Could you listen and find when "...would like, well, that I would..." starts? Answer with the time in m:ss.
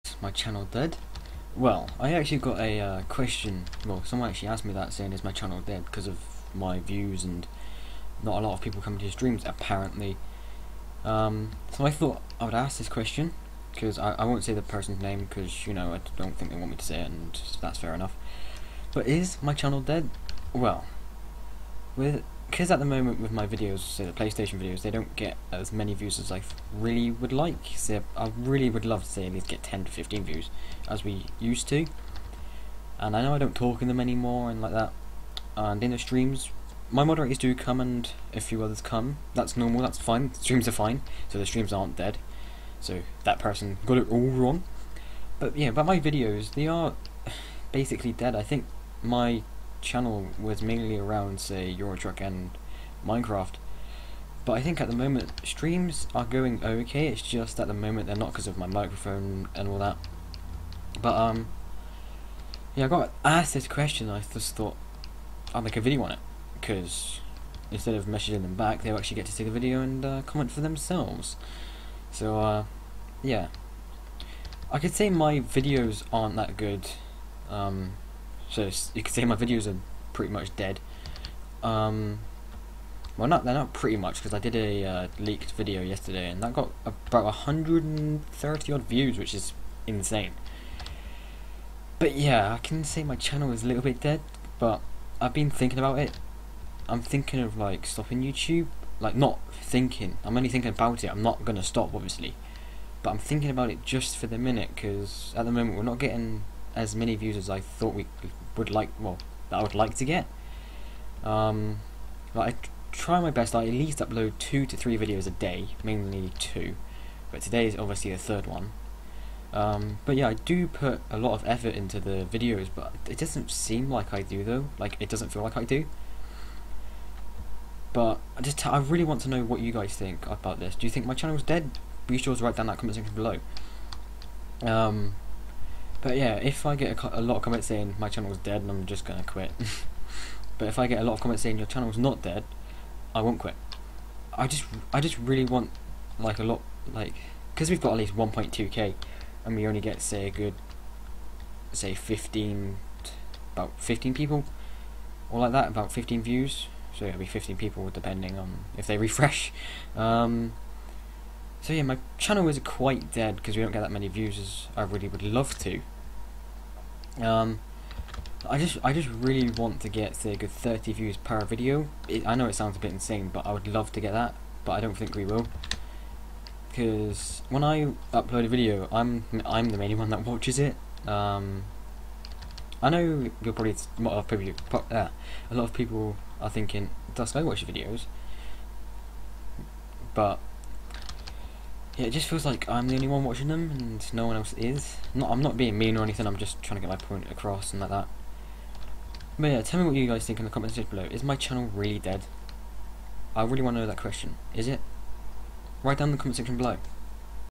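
1:48.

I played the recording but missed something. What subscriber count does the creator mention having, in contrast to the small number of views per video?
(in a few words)
1.2k.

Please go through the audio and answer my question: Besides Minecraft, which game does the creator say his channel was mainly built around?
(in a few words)
Euro Truck.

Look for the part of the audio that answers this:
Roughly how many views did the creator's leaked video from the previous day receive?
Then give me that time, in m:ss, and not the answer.
1:27.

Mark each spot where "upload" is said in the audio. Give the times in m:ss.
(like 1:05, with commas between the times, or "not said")
1:53, 2:58.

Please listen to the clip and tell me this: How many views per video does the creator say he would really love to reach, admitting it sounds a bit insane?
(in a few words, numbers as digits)
30.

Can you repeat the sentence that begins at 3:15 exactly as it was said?
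Not, I'm not being mean or anything, I'm just trying to get my point across and like that.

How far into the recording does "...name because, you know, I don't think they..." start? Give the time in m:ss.
0:15.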